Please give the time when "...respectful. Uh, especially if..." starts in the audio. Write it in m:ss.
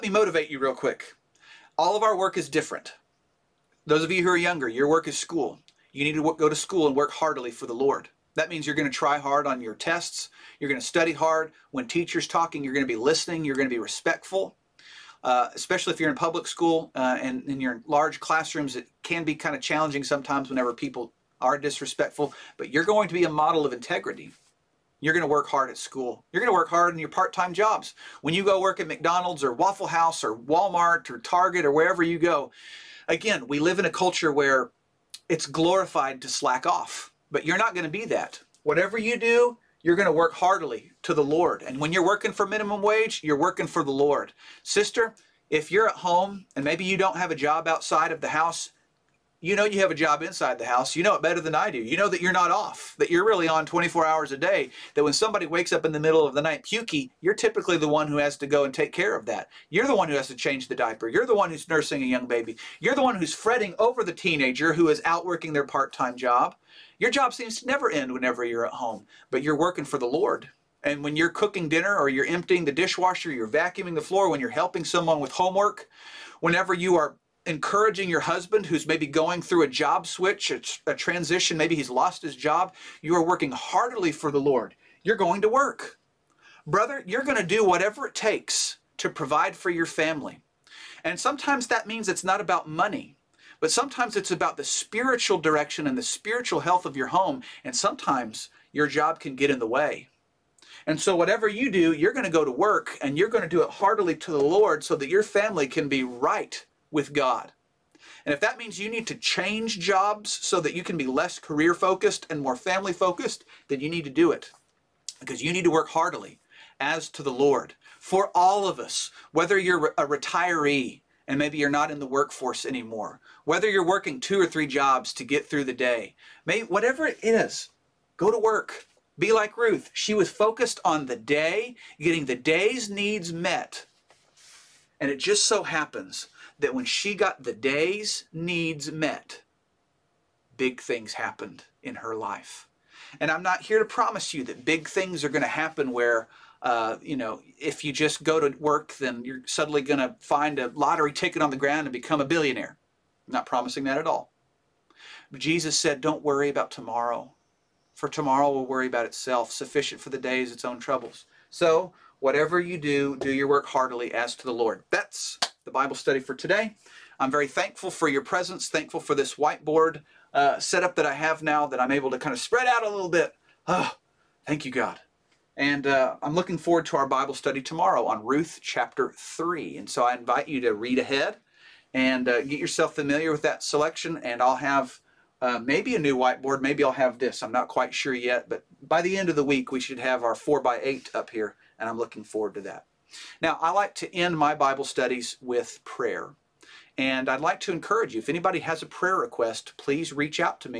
0:13.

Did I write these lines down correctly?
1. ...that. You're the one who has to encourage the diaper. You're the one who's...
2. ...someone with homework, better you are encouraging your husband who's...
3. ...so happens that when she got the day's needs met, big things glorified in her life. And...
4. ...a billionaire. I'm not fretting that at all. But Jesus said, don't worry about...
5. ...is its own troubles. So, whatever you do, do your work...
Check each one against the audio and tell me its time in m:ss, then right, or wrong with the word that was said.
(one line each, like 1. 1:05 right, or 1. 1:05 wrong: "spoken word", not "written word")
1. 0:59 wrong: "change", not "encourage"
2. 1:14 wrong: "whenever", not "better"
3. 2:15 wrong: "happened", not "glorified"
4. 2:32 wrong: "promising", not "fretting"
5. 2:40 right.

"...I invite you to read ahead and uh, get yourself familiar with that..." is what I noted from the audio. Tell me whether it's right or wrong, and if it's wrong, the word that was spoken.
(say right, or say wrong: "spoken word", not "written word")
right.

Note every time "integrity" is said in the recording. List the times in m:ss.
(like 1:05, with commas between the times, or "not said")
0:23.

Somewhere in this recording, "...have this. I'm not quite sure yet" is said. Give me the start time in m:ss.
3:06.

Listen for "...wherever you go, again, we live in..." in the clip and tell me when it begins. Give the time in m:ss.
0:31.